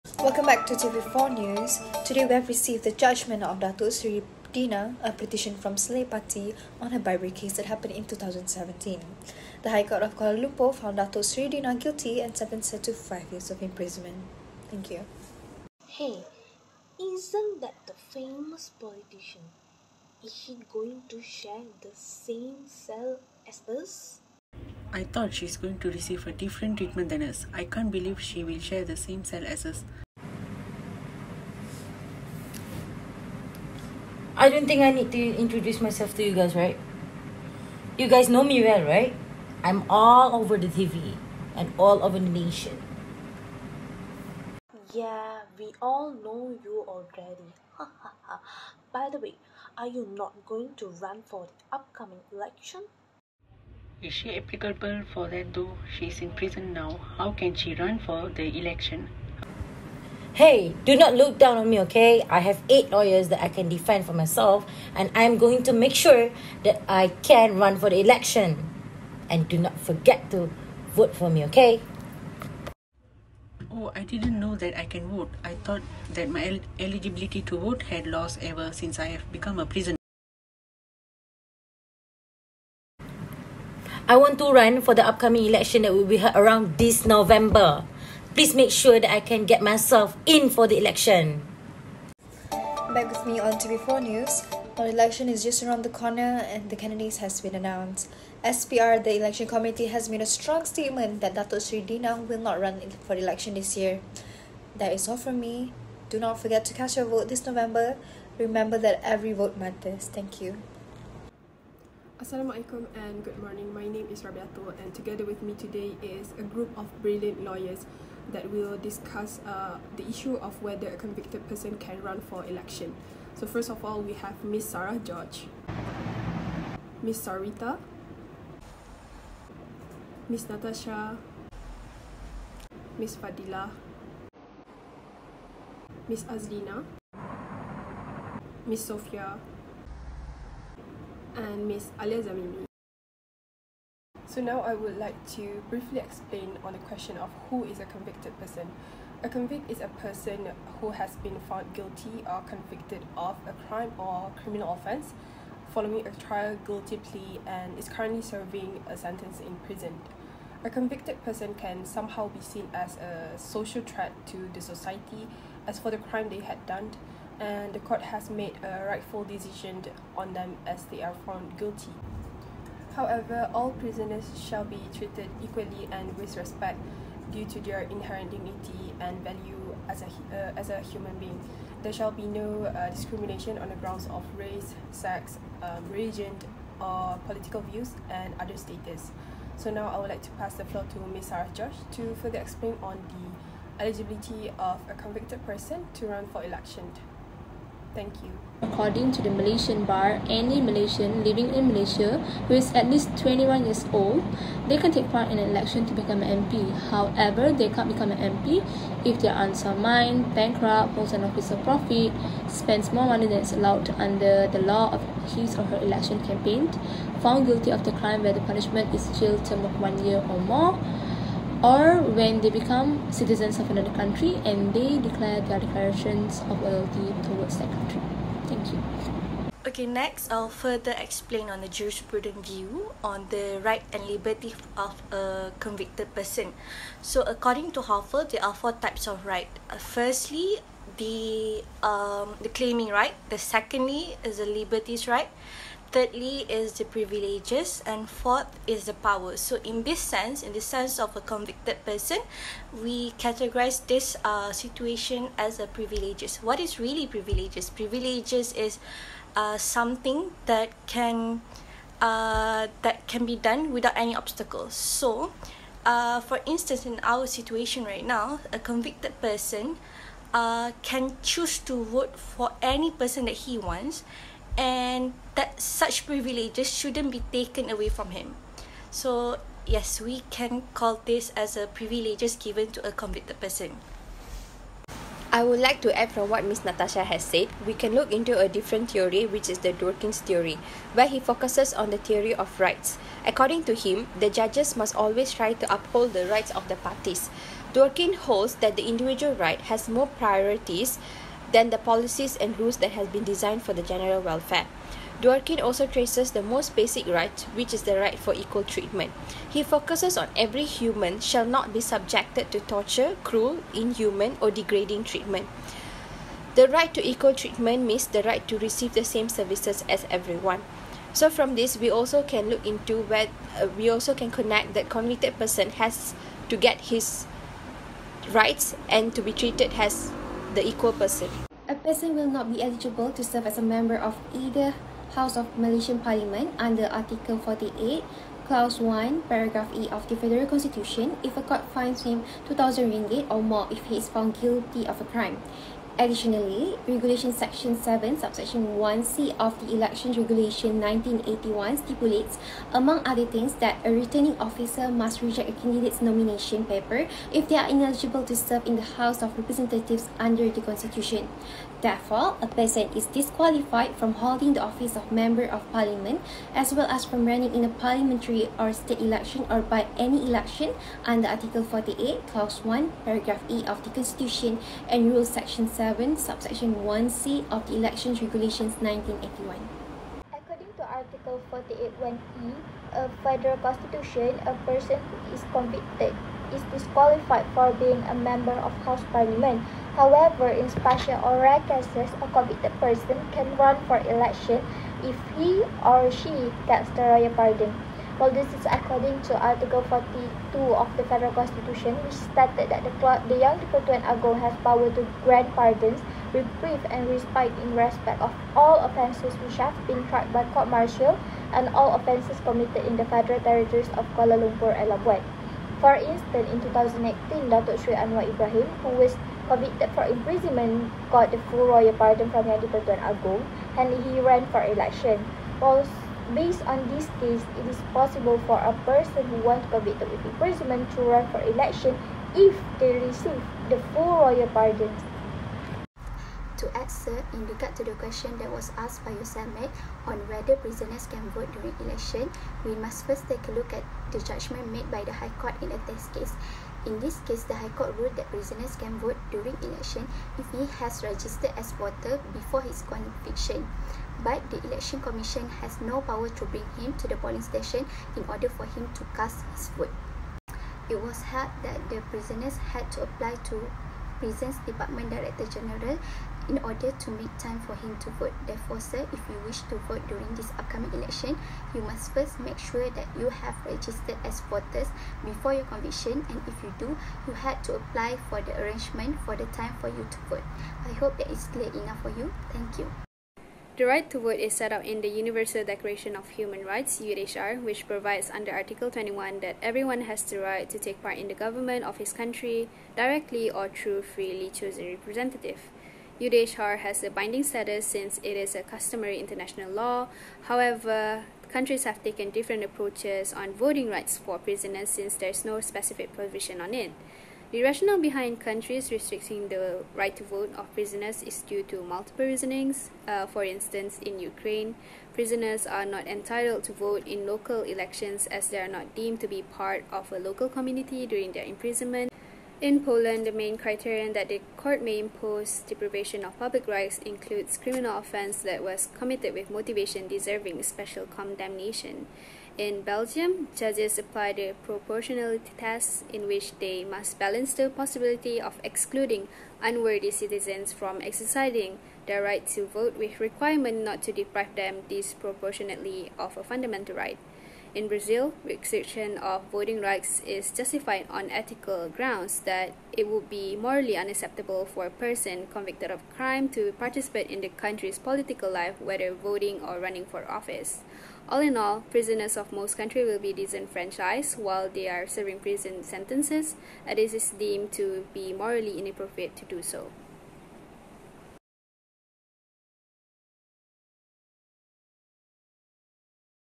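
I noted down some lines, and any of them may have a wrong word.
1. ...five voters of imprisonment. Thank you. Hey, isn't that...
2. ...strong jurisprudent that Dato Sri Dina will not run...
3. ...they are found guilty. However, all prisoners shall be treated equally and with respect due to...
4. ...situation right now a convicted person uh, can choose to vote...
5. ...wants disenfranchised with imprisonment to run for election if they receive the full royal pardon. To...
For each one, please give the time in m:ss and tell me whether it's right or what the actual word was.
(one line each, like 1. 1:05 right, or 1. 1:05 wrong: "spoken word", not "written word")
1. 0:12 wrong: "years", not "voters"
2. 1:40 wrong: "statement", not "jurisprudent"
3. 2:50 right
4. 4:27 right
5. 7:09 wrong: "convicted", not "disenfranchised".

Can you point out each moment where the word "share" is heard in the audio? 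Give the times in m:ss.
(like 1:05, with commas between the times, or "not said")
0:21, 0:28.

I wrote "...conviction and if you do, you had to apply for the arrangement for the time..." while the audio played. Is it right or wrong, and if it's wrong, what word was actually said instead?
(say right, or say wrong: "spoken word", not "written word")
right.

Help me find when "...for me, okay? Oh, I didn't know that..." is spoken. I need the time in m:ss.
1:11.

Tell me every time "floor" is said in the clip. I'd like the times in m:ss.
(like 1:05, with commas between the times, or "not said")
3:10.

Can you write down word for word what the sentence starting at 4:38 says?
So yes, we can call this as a privileges given to a convicted person.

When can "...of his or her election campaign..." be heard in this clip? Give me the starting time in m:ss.
3:34.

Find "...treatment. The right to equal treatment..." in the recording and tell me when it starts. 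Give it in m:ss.
5:15.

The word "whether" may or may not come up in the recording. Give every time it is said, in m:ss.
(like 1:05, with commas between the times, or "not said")
2:00, 7:20, 9:18.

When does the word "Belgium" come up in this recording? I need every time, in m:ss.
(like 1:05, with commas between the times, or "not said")
8:52.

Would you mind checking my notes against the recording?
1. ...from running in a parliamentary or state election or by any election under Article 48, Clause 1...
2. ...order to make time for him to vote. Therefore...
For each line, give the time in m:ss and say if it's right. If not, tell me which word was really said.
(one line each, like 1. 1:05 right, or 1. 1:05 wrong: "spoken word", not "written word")
1. 6:07 right
2. 7:46 right.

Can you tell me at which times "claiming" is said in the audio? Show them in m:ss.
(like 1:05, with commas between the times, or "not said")
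4:02.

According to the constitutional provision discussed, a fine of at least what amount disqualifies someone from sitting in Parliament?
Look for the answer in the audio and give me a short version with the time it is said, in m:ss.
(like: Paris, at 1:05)
2,000 ringgit, at 5:42.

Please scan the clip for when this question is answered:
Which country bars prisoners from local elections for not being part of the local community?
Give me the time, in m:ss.
8:34.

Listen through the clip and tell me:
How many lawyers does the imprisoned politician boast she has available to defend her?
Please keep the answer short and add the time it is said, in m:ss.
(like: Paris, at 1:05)
8, at 1:02.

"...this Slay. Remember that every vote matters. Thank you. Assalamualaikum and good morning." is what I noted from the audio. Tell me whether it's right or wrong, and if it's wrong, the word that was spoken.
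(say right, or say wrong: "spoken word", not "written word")
wrong: "November", not "Slay".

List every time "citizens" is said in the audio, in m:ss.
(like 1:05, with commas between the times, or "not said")
3:43, 9:00.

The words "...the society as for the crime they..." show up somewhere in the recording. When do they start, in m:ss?
2:44.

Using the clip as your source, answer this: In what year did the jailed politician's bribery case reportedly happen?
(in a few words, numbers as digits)
2017.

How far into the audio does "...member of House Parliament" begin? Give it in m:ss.
6:28.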